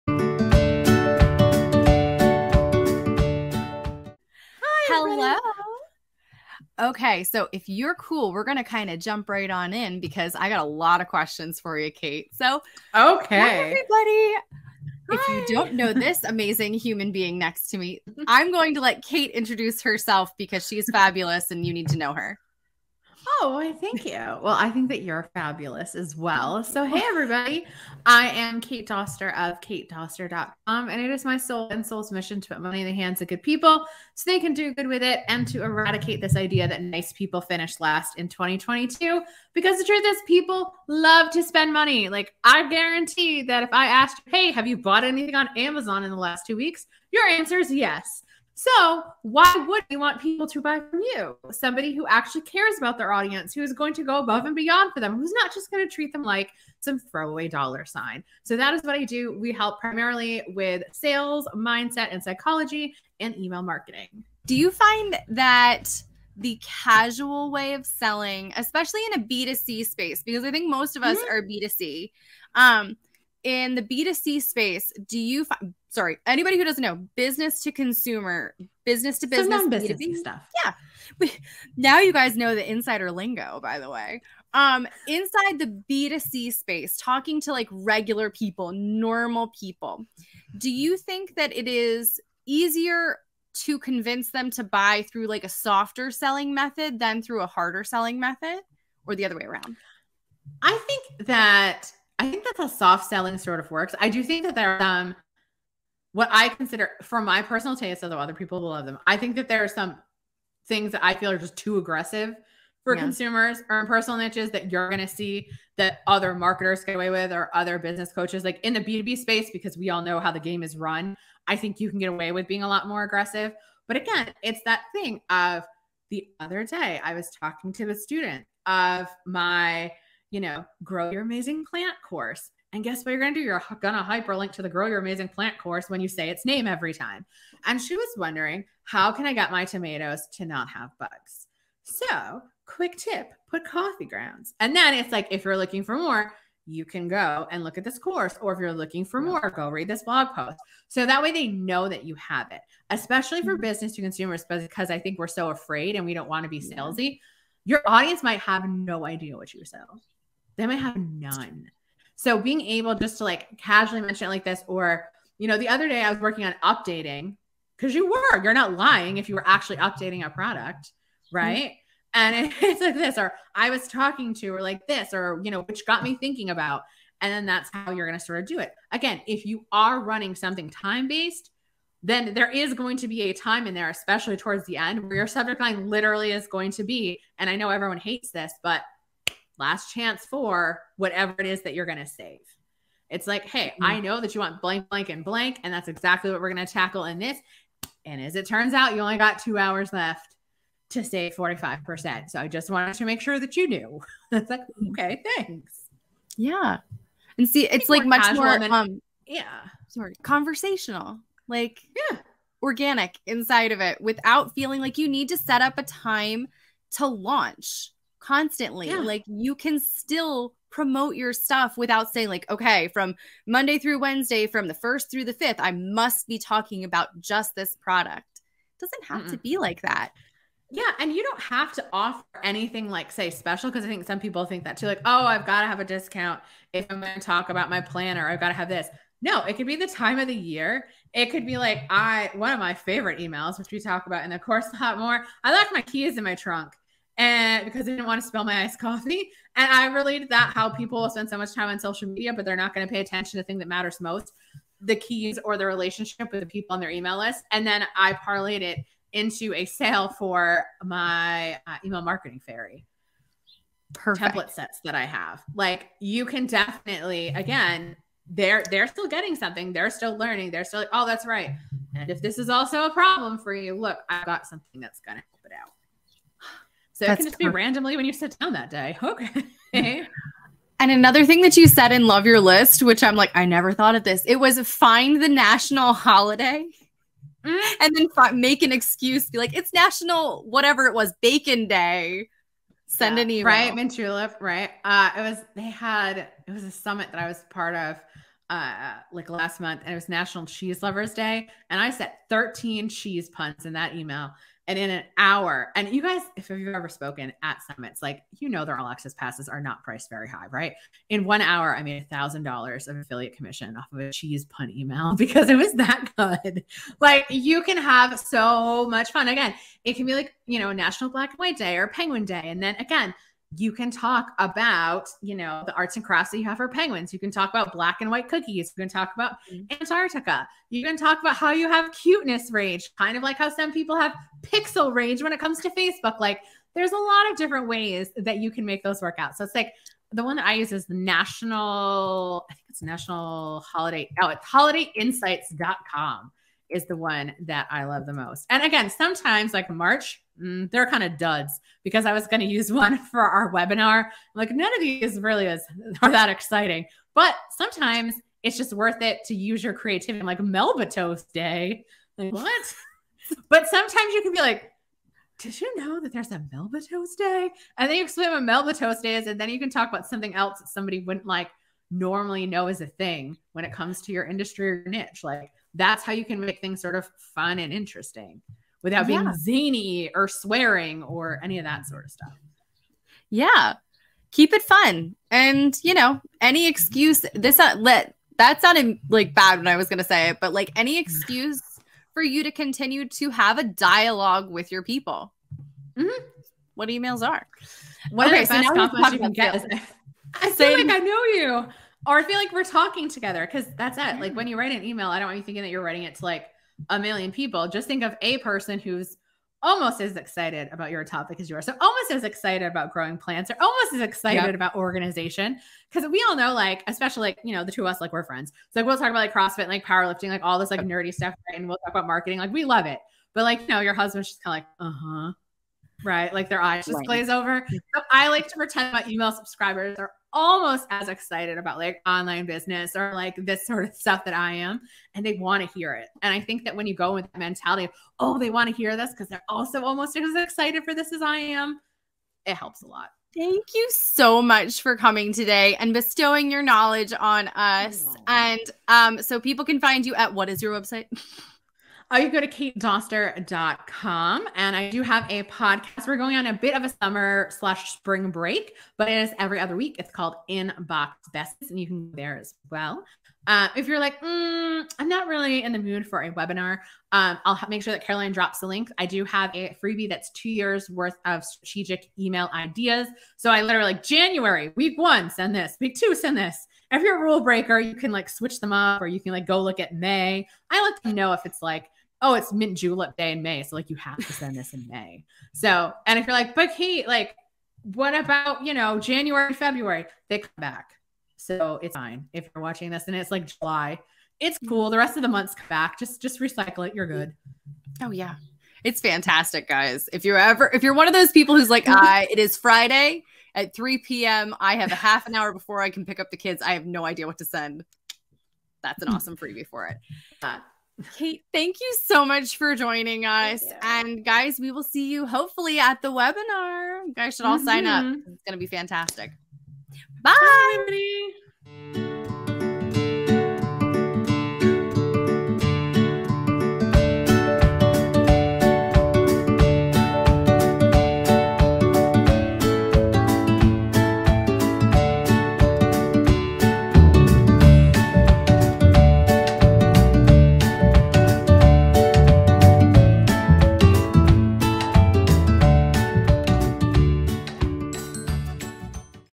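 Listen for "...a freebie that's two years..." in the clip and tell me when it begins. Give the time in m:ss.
7:49.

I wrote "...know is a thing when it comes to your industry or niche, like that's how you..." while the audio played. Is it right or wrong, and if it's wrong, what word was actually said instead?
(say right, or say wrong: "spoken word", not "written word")
right.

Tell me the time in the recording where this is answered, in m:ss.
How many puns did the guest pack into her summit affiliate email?
5:02.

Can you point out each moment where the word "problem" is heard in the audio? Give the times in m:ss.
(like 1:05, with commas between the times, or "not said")
4:32.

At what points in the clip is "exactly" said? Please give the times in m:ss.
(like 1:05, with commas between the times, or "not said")
3:15.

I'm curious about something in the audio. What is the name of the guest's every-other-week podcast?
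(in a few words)
Inbox Besties.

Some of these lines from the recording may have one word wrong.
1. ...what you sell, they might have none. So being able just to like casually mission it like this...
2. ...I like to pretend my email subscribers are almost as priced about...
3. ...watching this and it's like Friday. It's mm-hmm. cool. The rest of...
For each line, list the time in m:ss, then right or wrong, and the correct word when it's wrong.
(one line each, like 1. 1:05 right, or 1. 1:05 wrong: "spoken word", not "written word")
1. 2:39 wrong: "mention", not "mission"
2. 7:08 wrong: "excited", not "priced"
3. 8:12 wrong: "July", not "Friday".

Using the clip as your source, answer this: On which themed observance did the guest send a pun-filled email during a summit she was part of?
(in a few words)
National Cheese Lovers Day.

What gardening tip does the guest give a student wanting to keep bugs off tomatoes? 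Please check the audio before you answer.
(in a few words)
coffee grounds.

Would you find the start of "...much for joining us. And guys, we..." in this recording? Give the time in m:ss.
8:32.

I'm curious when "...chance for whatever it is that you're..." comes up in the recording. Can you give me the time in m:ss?
3:09.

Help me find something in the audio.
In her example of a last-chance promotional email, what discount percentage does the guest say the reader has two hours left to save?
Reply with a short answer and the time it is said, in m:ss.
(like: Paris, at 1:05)
45%, at 3:21.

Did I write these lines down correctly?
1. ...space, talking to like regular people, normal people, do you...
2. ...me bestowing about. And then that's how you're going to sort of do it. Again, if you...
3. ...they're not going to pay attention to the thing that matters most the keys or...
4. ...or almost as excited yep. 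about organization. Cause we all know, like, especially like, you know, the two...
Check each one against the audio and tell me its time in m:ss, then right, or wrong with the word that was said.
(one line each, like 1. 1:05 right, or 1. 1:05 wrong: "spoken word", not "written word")
1. 1:26 right
2. 2:56 wrong: "thinking", not "bestowing"
3. 4:12 right
4. 6:53 right.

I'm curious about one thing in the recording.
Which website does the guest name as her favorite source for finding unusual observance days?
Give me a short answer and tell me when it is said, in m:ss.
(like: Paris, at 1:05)
holidayinsights.com, at 5:44.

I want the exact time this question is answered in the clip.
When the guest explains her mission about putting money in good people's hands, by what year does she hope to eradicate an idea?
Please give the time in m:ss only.
0:38.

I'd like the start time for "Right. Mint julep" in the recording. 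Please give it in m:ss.
4:53.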